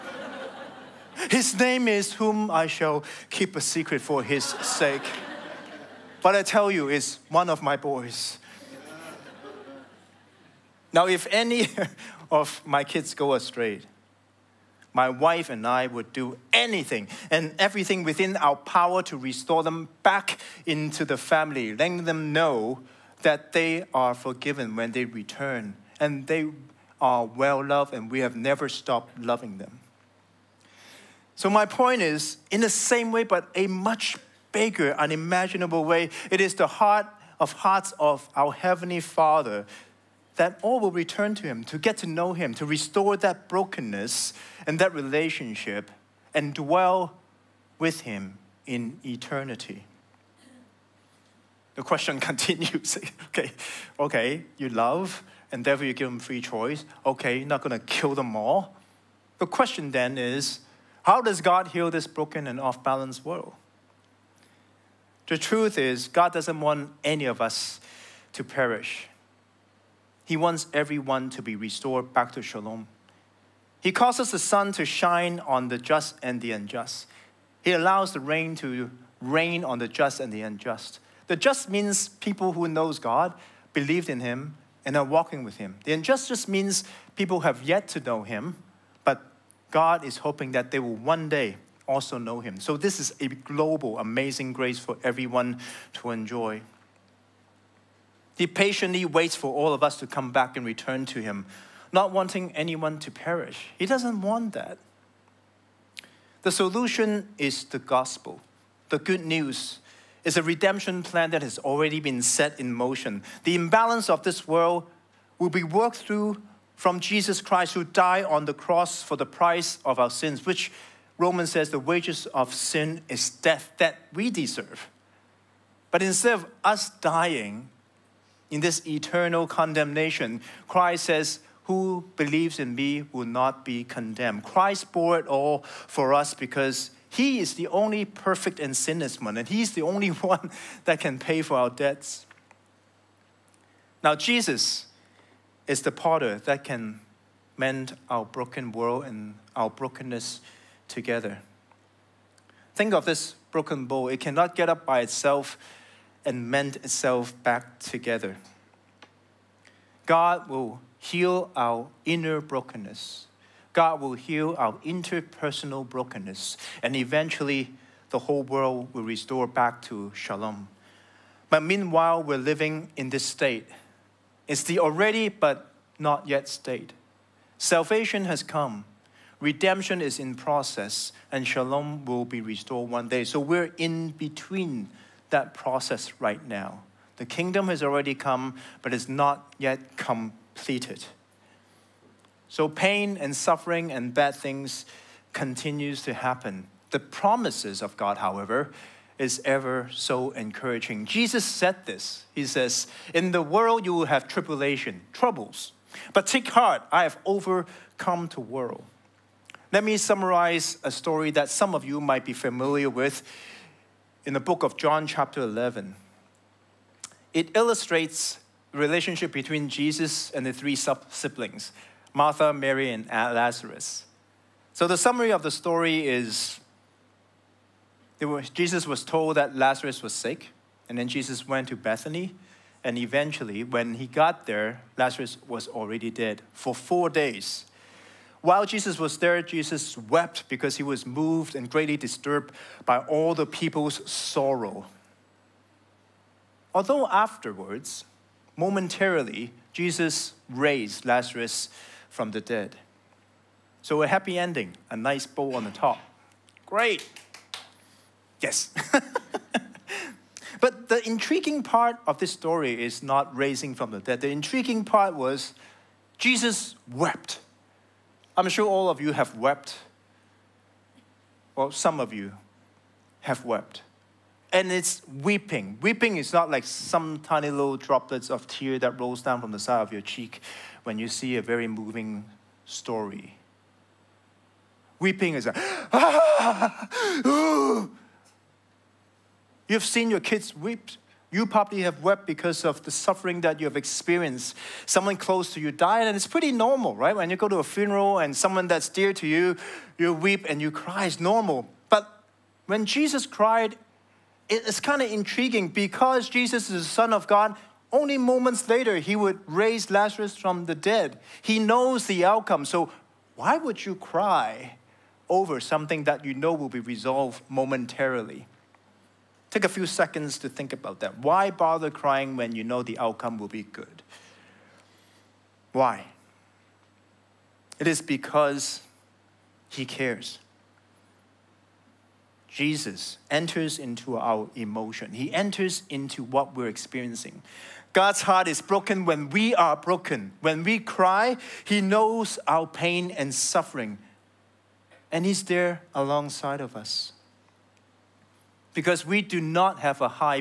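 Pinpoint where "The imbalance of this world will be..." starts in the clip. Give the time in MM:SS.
01:53.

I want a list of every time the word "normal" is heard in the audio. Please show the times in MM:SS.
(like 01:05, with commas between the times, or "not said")
04:56, 05:01.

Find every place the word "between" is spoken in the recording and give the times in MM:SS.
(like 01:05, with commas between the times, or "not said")
03:04, 03:39.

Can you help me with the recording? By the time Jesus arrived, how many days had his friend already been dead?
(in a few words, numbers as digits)
4.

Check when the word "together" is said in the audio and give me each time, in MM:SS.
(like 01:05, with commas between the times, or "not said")
02:30, 02:37.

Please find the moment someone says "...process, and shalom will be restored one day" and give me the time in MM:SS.
03:00.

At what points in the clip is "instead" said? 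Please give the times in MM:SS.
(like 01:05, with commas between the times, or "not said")
02:06.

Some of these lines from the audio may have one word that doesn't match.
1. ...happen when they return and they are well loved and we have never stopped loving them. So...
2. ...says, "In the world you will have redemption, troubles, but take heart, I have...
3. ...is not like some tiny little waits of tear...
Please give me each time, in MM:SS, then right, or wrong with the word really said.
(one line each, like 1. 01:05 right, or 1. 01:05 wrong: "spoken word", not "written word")
1. 00:24 wrong: "forgiven", not "happen"
2. 03:22 wrong: "tribulation", not "redemption"
3. 04:36 wrong: "droplets", not "waits".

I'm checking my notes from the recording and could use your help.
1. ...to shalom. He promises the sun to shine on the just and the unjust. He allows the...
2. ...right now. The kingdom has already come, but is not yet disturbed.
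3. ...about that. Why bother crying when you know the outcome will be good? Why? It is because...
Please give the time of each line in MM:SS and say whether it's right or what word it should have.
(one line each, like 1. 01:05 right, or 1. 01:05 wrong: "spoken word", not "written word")
1. 01:12 wrong: "causes", not "promises"
2. 03:06 wrong: "completed", not "disturbed"
3. 05:20 right.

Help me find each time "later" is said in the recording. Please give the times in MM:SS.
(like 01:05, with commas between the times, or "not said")
05:08.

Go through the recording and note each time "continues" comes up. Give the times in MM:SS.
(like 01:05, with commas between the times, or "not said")
00:52, 03:15.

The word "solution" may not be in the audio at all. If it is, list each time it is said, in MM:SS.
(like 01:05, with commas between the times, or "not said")
01:46.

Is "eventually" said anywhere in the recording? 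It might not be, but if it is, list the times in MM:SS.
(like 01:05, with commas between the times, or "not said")
02:46, 03:52.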